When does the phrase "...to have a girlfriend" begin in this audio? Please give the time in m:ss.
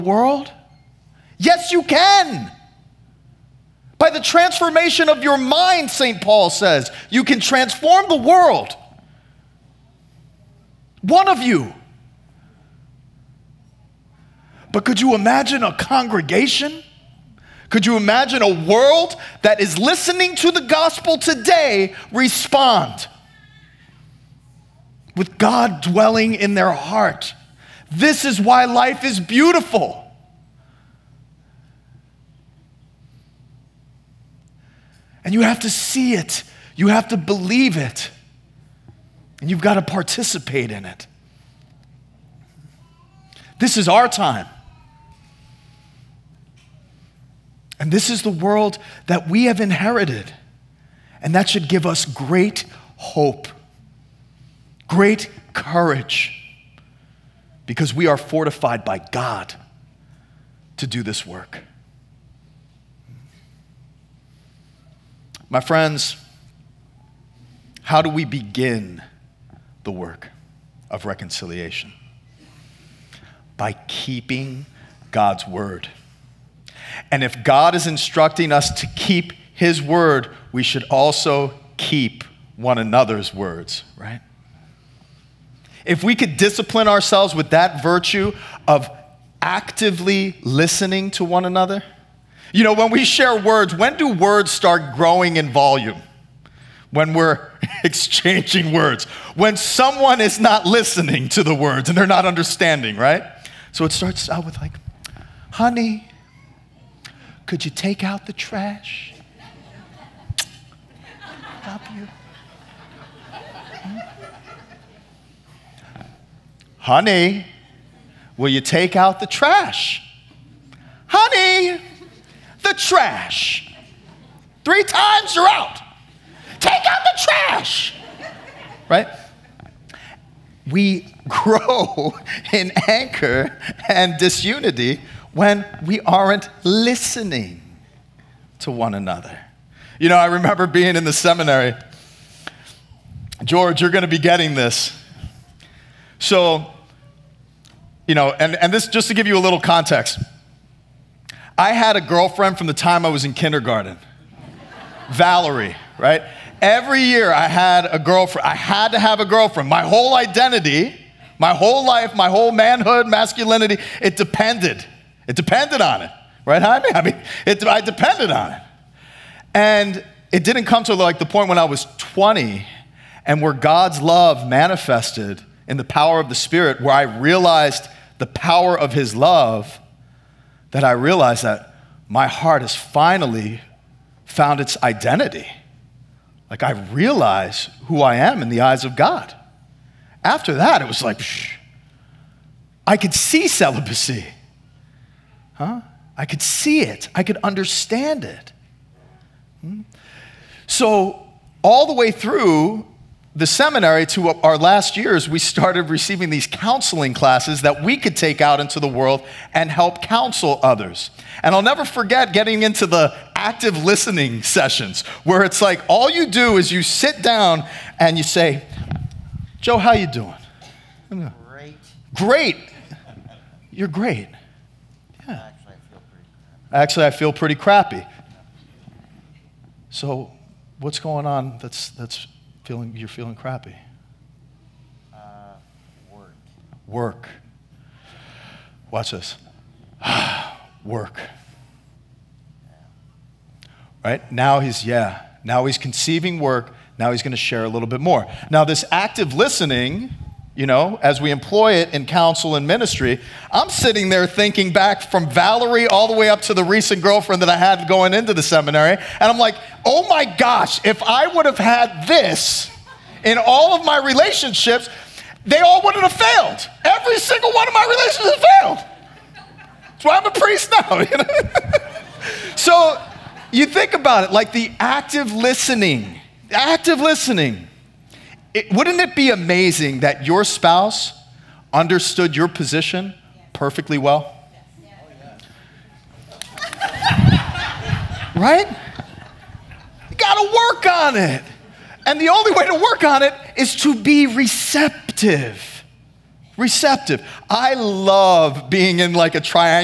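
2:38.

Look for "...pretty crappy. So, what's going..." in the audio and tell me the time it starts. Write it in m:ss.
3:47.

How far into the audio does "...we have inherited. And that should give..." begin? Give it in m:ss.
0:49.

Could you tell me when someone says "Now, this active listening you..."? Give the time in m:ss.
4:08.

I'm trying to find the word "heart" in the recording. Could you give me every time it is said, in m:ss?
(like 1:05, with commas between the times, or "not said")
0:26, 3:02.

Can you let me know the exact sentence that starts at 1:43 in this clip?
So it starts out with, like, honey, could you take out the trash?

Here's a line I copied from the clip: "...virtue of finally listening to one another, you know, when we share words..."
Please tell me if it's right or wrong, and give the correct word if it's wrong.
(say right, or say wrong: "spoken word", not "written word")
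wrong: "actively", not "finally".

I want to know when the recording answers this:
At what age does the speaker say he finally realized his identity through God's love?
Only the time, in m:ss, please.
2:51.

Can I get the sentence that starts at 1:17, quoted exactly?
And if God is instructing us to keep his word, we should also keep one another's words, right?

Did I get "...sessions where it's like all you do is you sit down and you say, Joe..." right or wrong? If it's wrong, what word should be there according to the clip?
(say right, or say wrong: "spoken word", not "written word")
right.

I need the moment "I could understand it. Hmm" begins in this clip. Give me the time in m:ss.
3:17.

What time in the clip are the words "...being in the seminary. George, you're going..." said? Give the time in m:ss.
2:20.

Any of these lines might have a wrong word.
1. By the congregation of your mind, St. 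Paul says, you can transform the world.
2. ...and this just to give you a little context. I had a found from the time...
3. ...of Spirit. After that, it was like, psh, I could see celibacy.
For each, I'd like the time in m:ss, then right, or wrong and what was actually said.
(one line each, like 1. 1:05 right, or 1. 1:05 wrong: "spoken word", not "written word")
1. 0:03 wrong: "transformation", not "congregation"
2. 2:28 wrong: "girlfriend", not "found"
3. 3:08 wrong: "God", not "Spirit".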